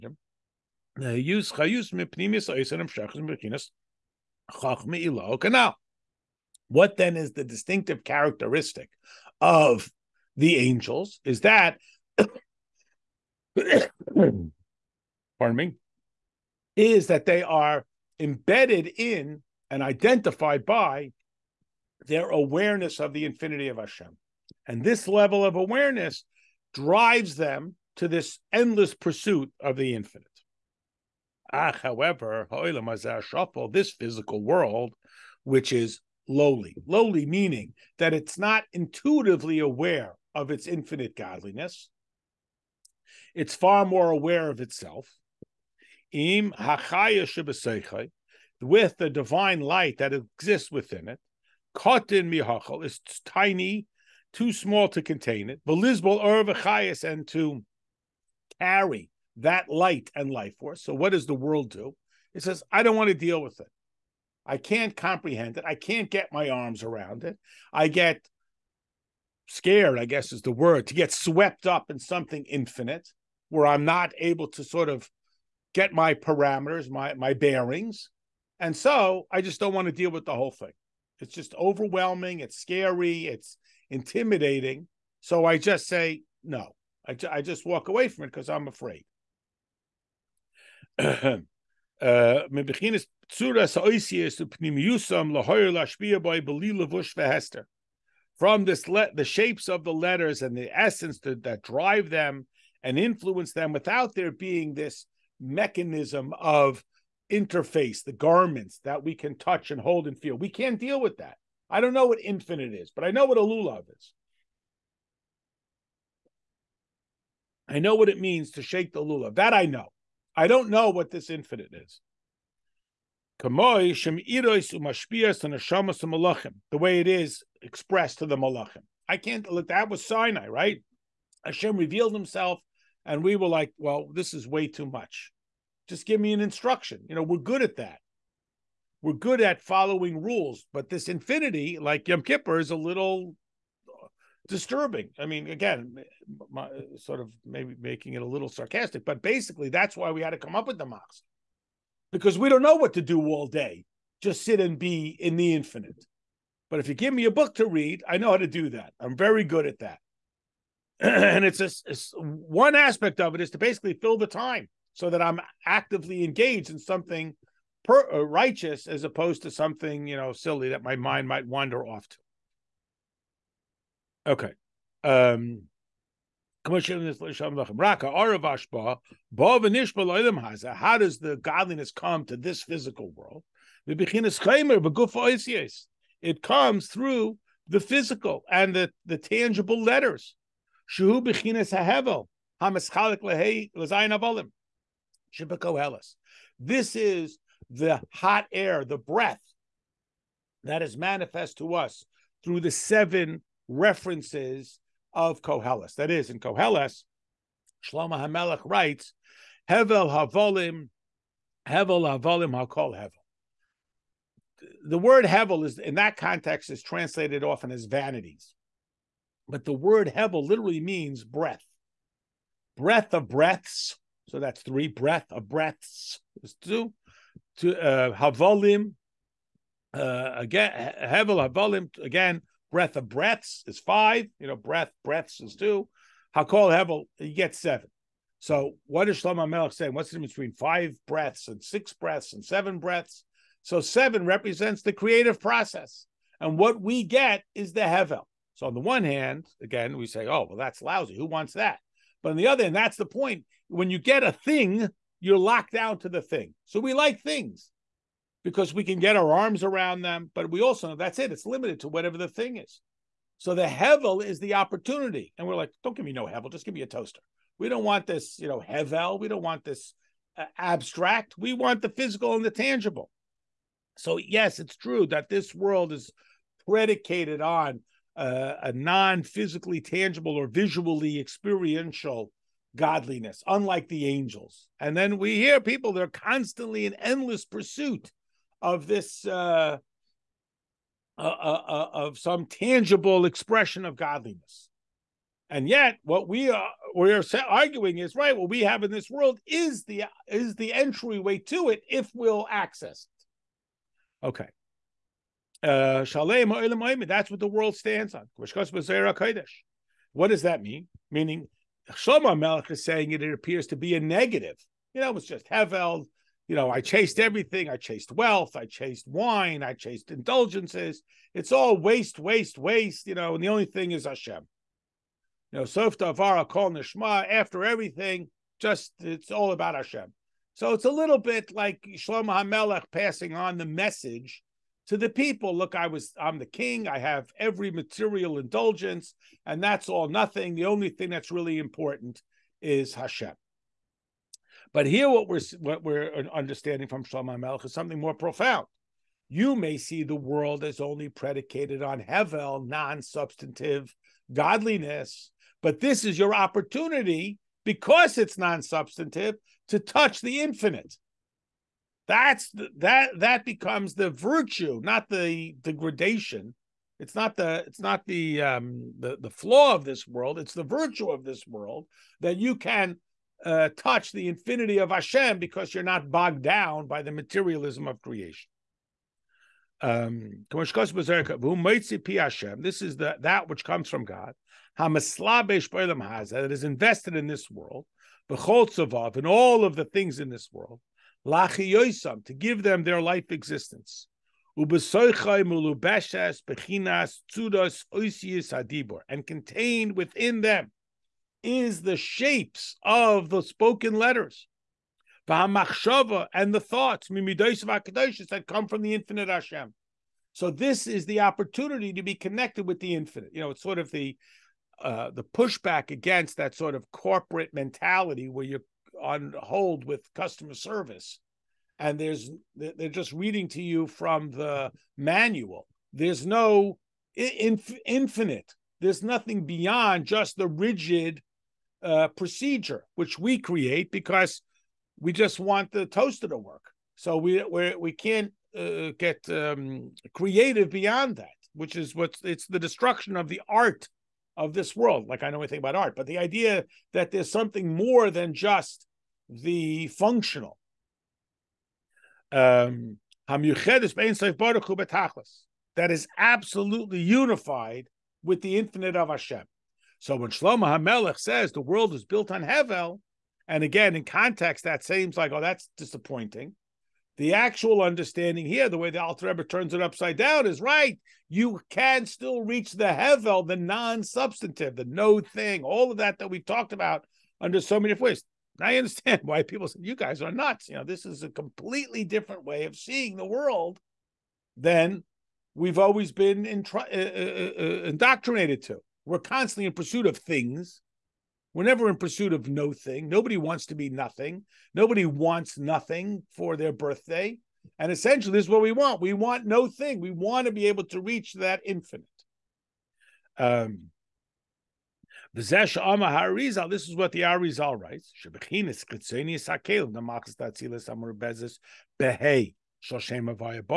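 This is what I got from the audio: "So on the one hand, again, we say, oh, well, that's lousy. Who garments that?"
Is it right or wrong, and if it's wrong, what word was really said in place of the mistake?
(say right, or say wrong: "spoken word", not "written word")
wrong: "wants", not "garments".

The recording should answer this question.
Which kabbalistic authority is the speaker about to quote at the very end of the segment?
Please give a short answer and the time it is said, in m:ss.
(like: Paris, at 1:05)
Arizal, at 8:27.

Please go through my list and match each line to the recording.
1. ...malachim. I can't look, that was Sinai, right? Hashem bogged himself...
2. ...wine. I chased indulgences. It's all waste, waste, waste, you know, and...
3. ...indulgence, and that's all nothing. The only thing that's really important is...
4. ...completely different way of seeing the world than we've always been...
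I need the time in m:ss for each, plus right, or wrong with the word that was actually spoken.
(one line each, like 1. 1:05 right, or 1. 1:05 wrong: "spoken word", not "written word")
1. 2:08 wrong: "revealed", not "bogged"
2. 5:19 right
3. 5:38 right
4. 8:01 right.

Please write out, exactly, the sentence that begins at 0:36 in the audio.
Lowly meaning that it's not intuitively aware of its infinite godliness.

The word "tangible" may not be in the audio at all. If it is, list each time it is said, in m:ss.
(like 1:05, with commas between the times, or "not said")
4:32, 4:39, 4:52.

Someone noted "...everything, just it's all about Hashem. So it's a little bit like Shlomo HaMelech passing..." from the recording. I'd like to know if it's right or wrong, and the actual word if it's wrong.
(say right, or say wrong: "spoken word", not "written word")
right.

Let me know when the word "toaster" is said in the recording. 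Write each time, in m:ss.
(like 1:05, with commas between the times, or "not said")
4:26, 7:15.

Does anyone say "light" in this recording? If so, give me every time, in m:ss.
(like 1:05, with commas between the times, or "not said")
0:49, 0:59.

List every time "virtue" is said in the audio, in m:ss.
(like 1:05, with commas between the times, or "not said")
6:04, 6:10.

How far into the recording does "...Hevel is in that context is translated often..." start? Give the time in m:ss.
3:35.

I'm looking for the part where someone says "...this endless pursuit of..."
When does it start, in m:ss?
0:28.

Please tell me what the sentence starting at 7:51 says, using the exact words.
You can still reach the Hevel, the non-substantive, the no thing, all of that that we talked about under so many ways.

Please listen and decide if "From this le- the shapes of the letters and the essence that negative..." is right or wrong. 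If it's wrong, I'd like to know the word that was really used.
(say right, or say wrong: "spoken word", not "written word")
wrong: "drive", not "negative".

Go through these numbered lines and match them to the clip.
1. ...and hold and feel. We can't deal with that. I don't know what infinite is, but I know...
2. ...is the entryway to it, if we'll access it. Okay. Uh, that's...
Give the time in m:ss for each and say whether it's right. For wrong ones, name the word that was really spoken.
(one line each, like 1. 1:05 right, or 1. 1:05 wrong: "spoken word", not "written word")
1. 1:49 right
2. 5:00 right.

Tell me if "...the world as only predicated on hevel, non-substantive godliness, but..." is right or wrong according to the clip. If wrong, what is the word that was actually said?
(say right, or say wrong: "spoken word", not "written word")
right.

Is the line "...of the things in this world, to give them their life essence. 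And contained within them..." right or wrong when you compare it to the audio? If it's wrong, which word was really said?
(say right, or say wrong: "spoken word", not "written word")
wrong: "existence", not "essence".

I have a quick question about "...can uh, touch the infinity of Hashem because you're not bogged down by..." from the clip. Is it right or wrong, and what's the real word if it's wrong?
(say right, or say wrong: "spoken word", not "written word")
right.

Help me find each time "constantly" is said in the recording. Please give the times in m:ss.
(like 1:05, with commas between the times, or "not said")
4:46, 8:09.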